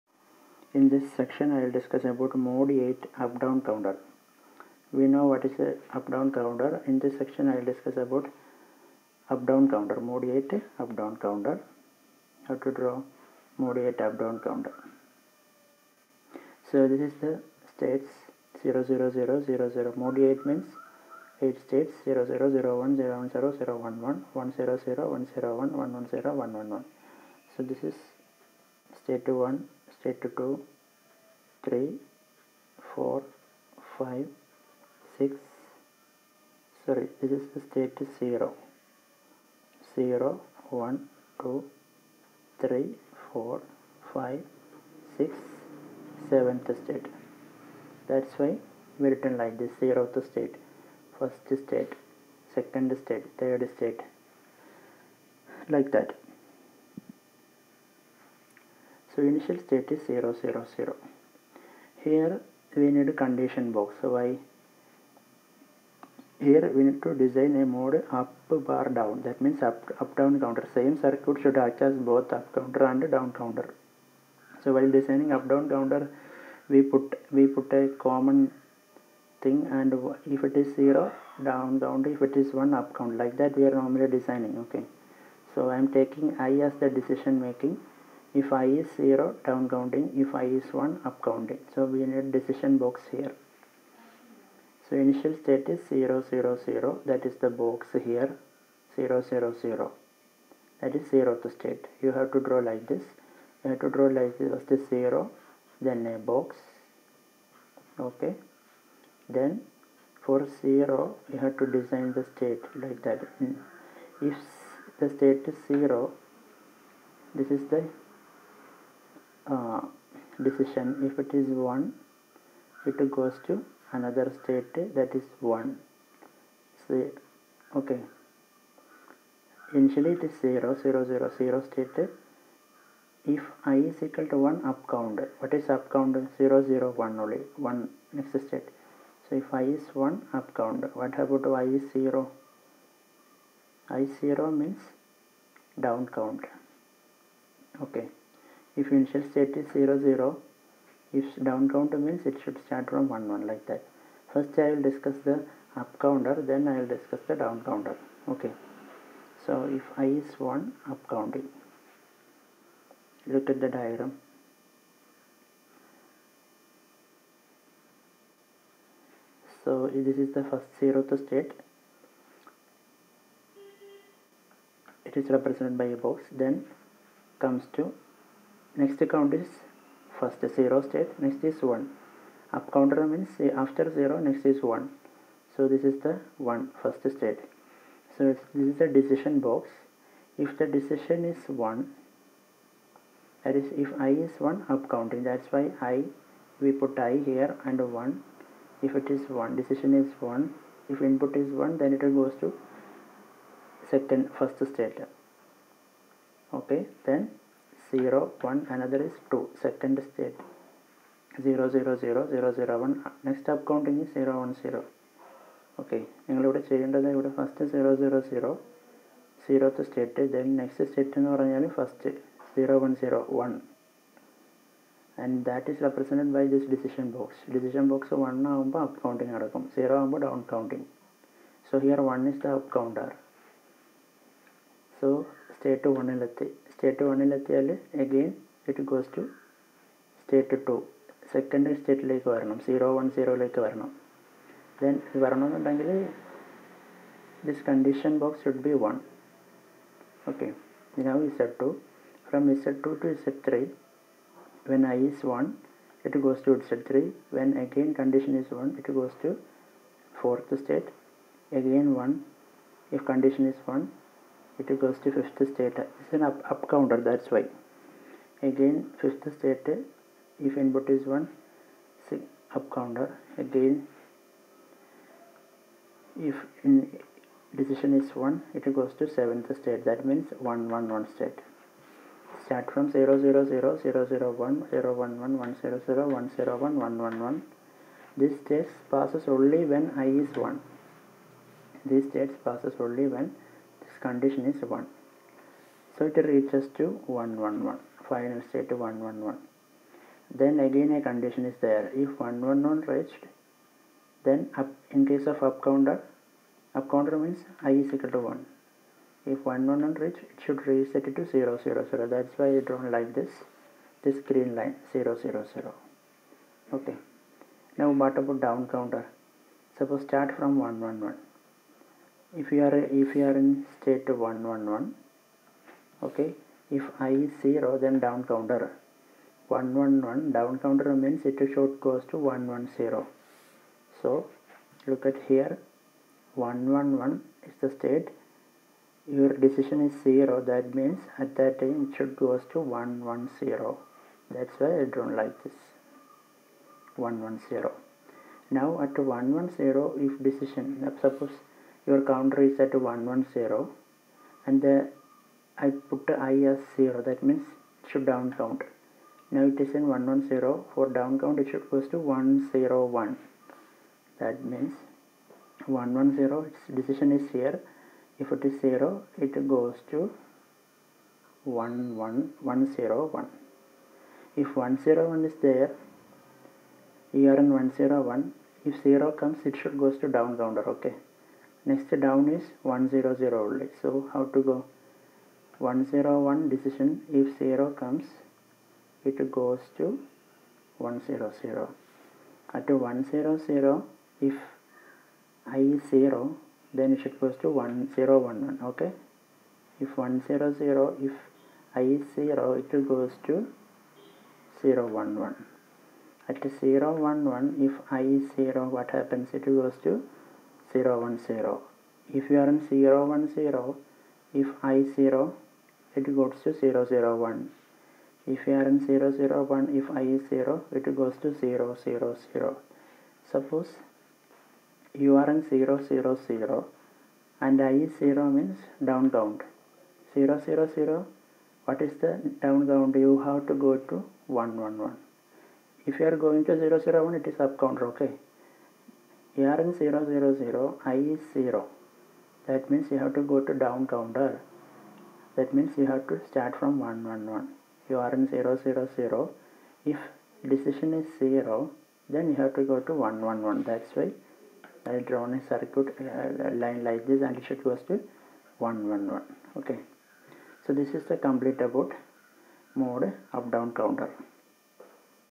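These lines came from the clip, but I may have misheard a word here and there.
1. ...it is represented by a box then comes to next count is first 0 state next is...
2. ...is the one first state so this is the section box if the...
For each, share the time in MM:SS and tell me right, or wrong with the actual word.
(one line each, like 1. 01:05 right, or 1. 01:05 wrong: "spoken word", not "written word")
1. 02:55 right
2. 03:05 wrong: "decision", not "section".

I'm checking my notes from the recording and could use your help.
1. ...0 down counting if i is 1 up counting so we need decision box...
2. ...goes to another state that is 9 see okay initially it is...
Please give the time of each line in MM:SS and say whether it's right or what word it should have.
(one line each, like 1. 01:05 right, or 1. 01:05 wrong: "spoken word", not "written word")
1. 01:28 right
2. 02:03 wrong: "1", not "9".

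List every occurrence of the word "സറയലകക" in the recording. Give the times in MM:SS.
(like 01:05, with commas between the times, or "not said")
04:03.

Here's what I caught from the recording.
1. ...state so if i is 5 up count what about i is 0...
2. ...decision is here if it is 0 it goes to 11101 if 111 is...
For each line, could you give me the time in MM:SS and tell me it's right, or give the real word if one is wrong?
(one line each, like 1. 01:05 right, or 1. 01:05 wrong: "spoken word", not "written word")
1. 02:18 wrong: "1", not "5"
2. 06:06 wrong: "101", not "111".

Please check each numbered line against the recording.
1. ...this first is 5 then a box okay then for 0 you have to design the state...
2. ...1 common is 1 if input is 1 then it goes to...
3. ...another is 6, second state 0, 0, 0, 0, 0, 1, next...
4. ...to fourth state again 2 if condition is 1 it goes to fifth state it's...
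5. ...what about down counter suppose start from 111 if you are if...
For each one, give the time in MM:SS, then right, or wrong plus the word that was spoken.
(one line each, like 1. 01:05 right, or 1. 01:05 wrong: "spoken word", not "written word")
1. 01:44 wrong: "0", not "5"
2. 03:19 wrong: "decision", not "common"
3. 03:28 wrong: "2", not "6"
4. 04:19 wrong: "1", not "2"
5. 05:18 right.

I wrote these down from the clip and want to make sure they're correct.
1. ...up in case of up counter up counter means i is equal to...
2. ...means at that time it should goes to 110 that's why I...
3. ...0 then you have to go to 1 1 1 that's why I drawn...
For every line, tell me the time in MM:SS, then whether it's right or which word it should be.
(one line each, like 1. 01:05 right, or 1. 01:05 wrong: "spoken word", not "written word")
1. 05:04 right
2. 05:40 right
3. 07:31 right.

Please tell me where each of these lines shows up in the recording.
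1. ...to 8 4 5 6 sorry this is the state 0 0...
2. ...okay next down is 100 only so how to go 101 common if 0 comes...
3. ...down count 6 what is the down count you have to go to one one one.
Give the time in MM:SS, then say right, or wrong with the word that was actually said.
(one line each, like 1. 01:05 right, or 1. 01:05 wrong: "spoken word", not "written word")
1. 00:30 wrong: "3", not "8"
2. 06:20 wrong: "decision", not "common"
3. 07:08 wrong: "0", not "6".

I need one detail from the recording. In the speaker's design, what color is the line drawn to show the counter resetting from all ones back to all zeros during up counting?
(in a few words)
Green.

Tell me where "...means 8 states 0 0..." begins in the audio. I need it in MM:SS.
00:20.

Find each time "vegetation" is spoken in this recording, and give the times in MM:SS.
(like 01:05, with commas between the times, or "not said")
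not said.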